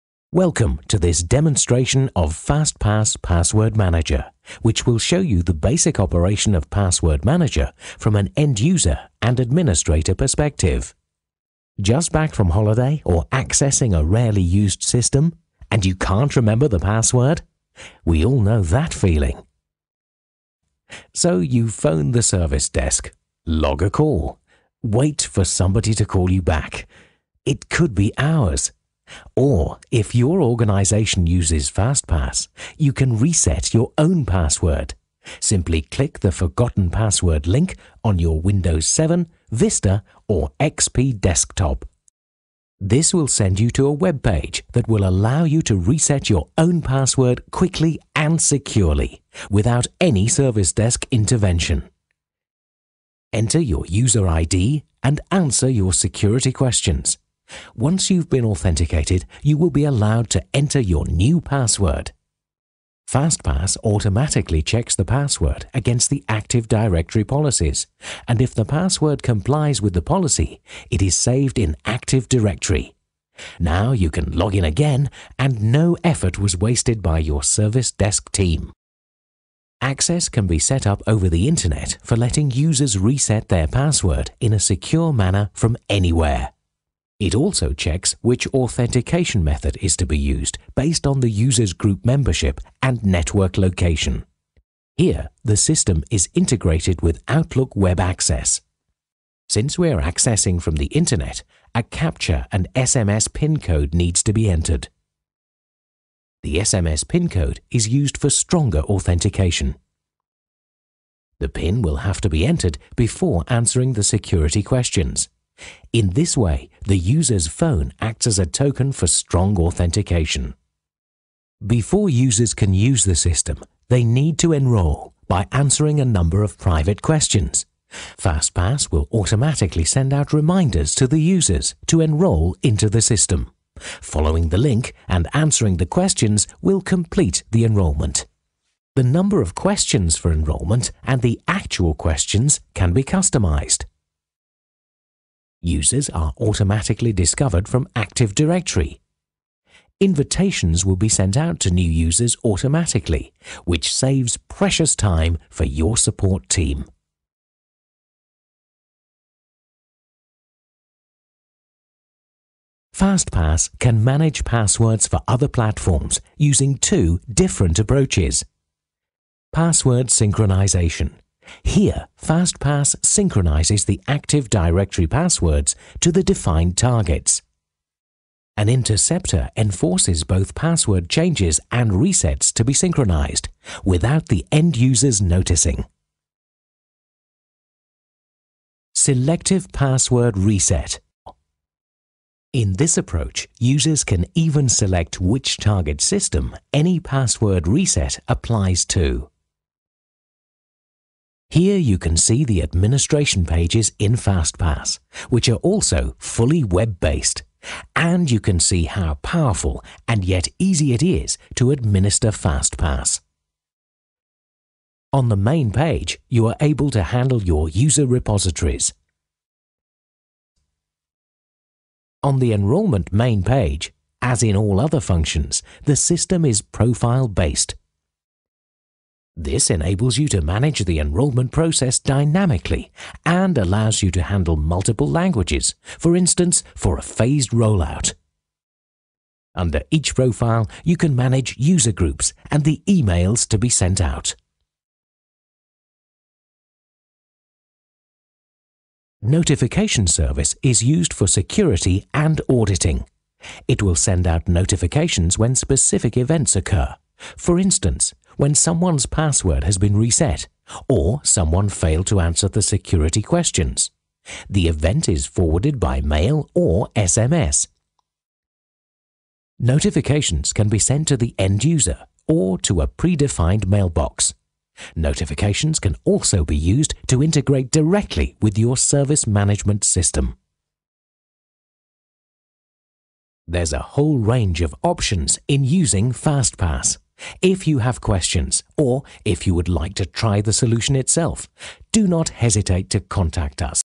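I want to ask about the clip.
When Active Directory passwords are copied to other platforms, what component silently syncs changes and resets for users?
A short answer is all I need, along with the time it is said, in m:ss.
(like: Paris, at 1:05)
An interceptor, at 2:58.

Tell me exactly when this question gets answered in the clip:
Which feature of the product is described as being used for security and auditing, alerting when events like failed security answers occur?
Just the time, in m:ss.
4:09.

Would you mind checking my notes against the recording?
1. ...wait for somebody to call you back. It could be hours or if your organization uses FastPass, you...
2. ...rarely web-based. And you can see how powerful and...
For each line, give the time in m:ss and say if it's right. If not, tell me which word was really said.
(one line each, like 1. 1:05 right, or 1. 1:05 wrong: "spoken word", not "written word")
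1. 0:24 right
2. 3:26 wrong: "fully", not "rarely".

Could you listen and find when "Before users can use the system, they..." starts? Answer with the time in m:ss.
2:01.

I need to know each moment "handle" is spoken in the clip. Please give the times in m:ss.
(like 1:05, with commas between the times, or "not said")
3:37, 3:54.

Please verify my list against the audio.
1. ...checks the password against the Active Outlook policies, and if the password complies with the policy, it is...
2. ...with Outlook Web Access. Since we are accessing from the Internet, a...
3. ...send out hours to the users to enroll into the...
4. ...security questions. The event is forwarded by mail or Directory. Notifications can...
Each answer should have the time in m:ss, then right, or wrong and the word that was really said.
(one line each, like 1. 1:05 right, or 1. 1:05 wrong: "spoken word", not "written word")
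1. 1:04 wrong: "Directory", not "Outlook"
2. 1:37 right
3. 2:09 wrong: "reminders", not "hours"
4. 4:22 wrong: "SMS", not "Directory".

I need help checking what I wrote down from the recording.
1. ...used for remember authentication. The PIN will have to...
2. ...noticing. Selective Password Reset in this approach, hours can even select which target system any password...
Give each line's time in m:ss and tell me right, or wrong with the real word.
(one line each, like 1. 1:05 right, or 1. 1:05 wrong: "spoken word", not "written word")
1. 1:47 wrong: "stronger", not "remember"
2. 3:05 wrong: "users", not "hours".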